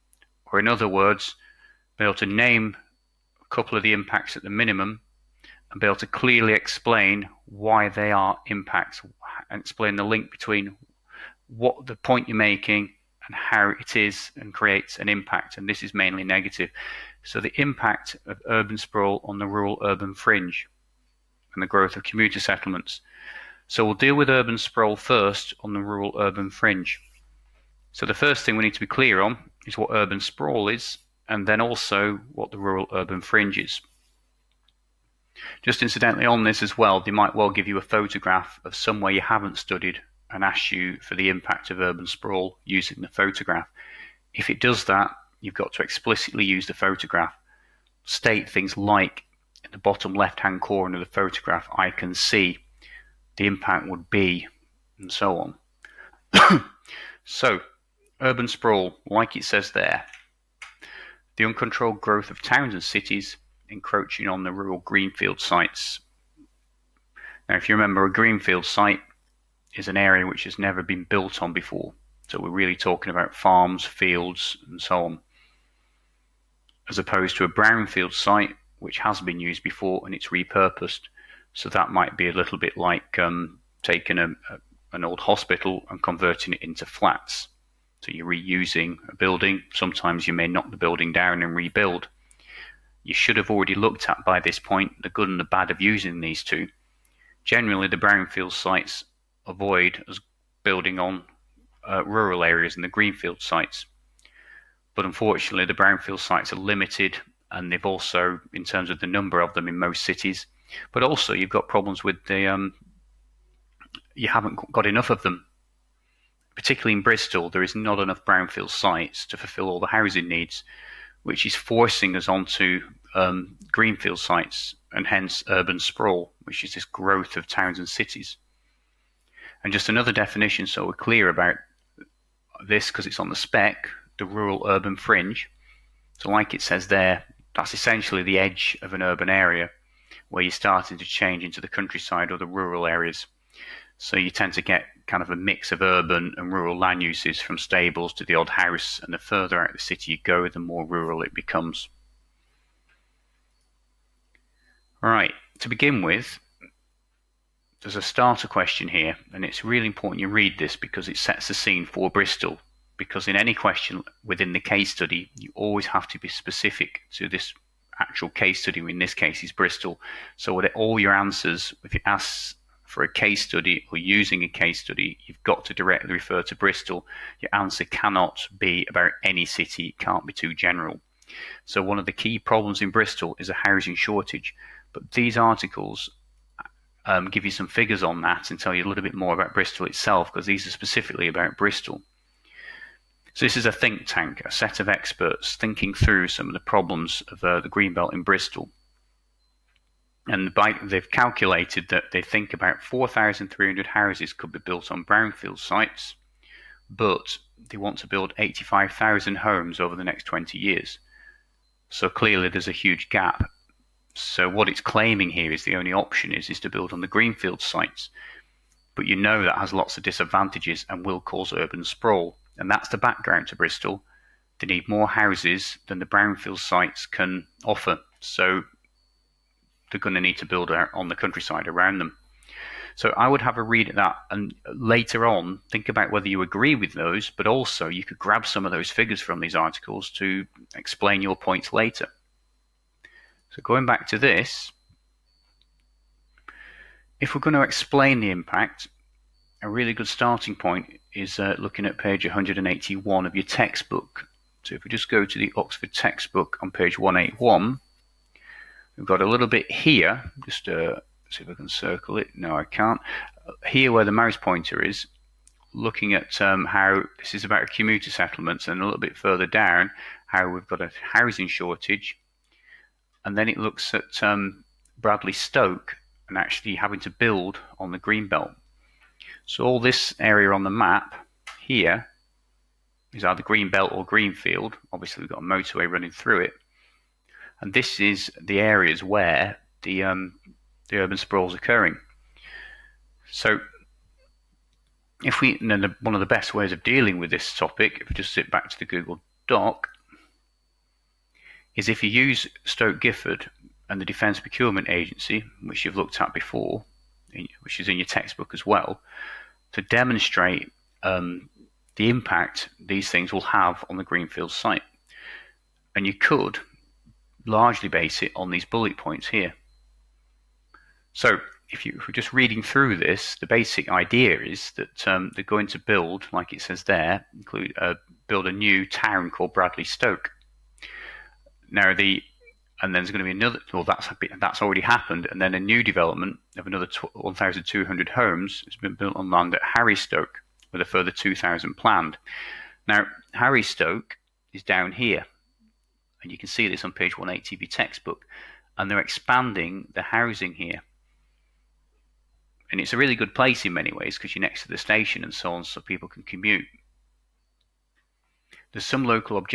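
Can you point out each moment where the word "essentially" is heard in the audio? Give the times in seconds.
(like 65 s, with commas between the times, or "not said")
137 s.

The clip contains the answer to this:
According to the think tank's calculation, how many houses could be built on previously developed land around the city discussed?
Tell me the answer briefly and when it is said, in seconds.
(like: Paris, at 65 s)
4,300, at 202 s.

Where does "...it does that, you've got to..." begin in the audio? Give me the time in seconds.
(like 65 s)
44 s.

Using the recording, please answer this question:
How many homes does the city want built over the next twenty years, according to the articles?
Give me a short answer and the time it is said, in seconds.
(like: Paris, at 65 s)
85,000, at 208 s.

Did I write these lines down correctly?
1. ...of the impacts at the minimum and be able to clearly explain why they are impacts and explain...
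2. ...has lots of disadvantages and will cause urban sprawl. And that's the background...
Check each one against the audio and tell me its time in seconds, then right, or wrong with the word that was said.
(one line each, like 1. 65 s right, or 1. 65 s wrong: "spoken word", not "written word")
1. 3 s right
2. 219 s right.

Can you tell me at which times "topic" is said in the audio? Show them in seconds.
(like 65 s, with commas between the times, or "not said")
297 s.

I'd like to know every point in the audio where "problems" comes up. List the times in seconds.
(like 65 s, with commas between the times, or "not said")
111 s, 182 s, 196 s.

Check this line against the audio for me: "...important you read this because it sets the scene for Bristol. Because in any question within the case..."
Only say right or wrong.
right.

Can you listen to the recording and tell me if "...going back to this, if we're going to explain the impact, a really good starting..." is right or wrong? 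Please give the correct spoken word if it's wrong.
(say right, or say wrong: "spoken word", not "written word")
right.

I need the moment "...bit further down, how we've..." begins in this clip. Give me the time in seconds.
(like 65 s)
268 s.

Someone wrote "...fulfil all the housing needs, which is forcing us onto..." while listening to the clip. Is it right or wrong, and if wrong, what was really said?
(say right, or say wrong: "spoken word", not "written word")
right.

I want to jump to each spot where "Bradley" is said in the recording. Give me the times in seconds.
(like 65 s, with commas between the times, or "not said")
274 s, 329 s.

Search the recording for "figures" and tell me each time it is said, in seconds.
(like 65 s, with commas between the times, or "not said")
187 s, 238 s.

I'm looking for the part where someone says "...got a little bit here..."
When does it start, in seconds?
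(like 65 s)
259 s.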